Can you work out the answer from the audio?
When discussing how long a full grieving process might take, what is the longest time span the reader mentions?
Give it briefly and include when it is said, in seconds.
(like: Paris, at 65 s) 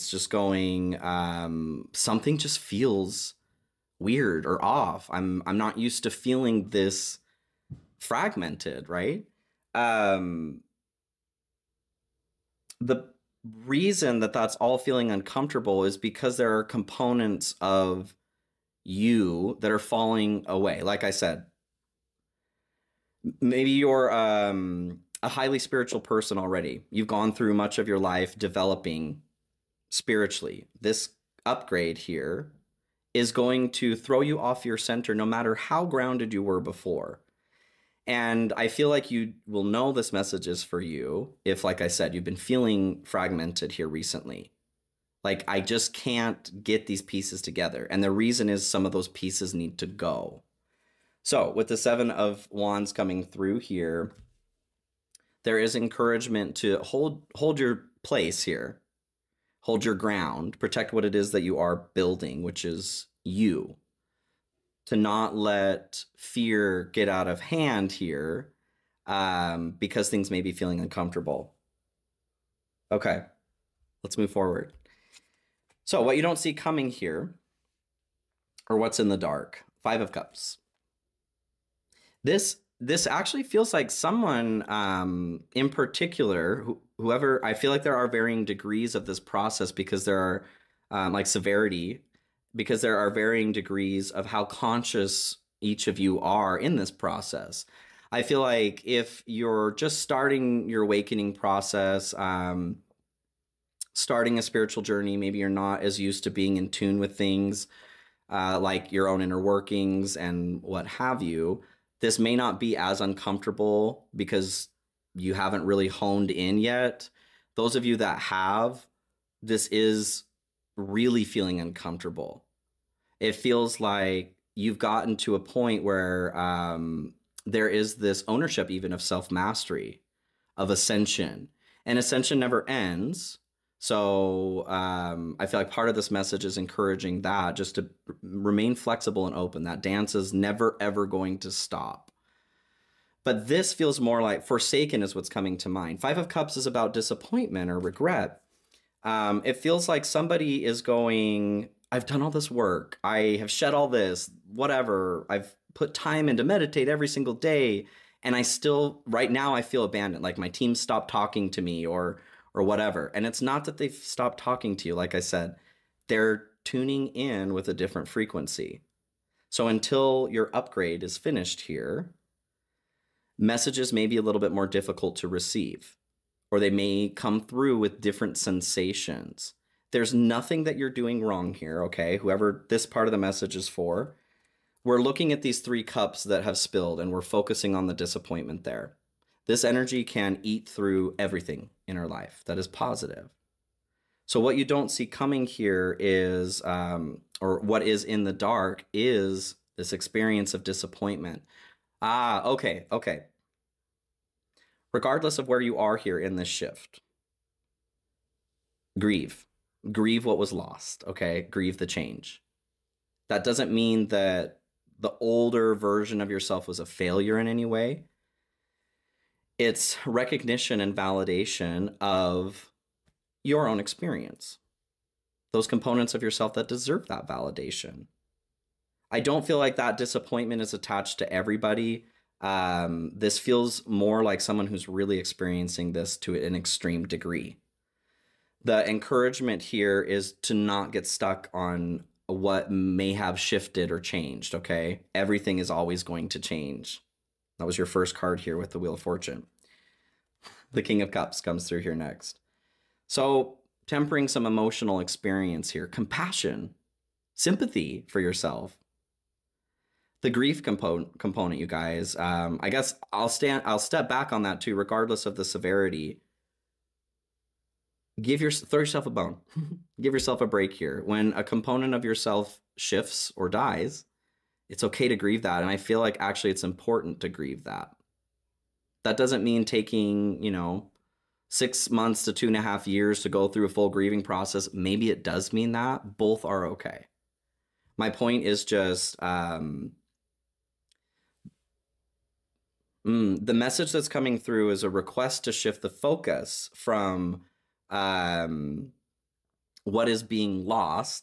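2 and a half years, at 282 s.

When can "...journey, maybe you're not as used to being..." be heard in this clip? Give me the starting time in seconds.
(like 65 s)
104 s.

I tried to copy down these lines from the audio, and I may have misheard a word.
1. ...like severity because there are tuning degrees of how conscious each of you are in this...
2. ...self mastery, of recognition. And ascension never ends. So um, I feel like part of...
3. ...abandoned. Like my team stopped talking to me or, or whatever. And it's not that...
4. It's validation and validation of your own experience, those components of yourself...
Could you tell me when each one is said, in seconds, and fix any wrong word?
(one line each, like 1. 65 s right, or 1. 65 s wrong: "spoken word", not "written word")
1. 91 s wrong: "varying", not "tuning"
2. 129 s wrong: "ascension", not "recognition"
3. 159 s right
4. 219 s wrong: "recognition", not "validation".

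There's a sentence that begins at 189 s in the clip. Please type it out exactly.
This energy can eat through everything in our life that is positive.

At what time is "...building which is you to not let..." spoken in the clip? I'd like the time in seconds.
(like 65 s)
61 s.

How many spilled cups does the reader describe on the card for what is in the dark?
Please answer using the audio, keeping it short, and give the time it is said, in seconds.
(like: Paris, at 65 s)
3, at 185 s.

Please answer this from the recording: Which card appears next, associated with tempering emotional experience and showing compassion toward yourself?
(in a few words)
King of Cups.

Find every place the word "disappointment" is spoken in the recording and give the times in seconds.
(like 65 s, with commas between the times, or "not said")
146 s, 187 s, 200 s, 229 s.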